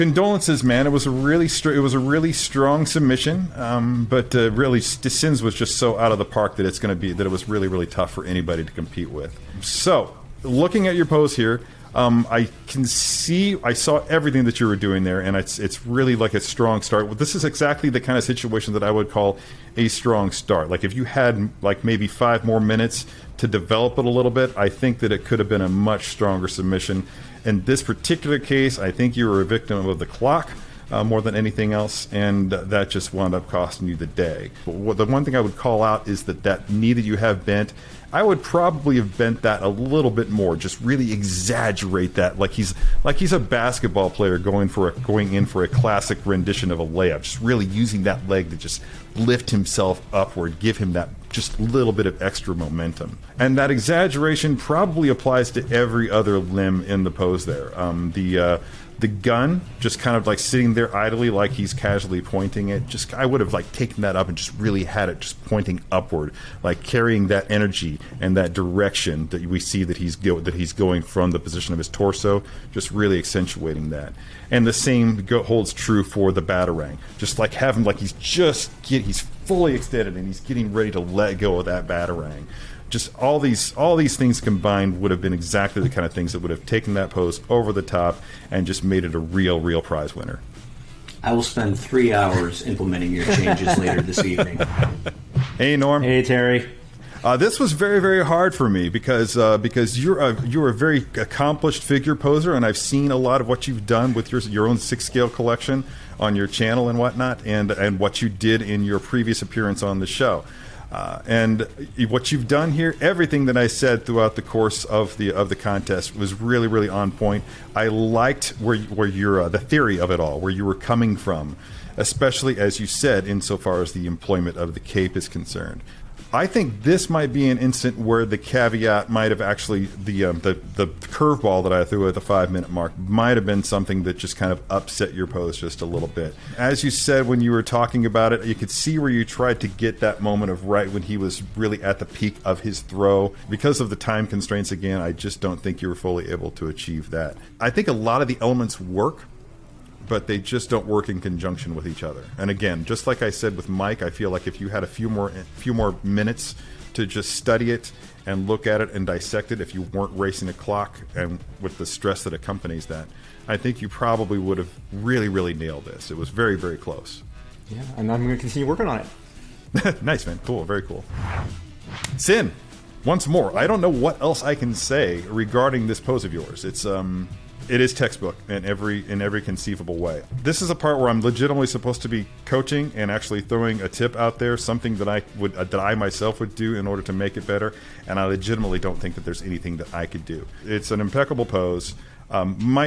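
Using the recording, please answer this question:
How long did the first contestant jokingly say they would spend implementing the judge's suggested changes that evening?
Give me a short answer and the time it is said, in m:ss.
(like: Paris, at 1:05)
3 hours, at 1:31.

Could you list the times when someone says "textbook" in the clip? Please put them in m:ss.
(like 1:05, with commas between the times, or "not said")
2:57.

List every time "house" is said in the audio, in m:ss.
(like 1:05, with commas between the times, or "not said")
not said.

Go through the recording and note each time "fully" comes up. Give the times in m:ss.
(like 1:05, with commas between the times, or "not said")
1:19, 2:25.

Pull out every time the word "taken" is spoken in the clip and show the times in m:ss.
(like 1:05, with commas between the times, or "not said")
1:03, 1:26.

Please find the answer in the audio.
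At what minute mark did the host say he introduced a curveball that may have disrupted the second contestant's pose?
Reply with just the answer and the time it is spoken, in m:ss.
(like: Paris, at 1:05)
5 minute mark, at 2:12.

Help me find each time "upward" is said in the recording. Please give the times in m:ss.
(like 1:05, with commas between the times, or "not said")
0:50, 1:05.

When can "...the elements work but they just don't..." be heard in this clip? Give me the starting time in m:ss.
2:28.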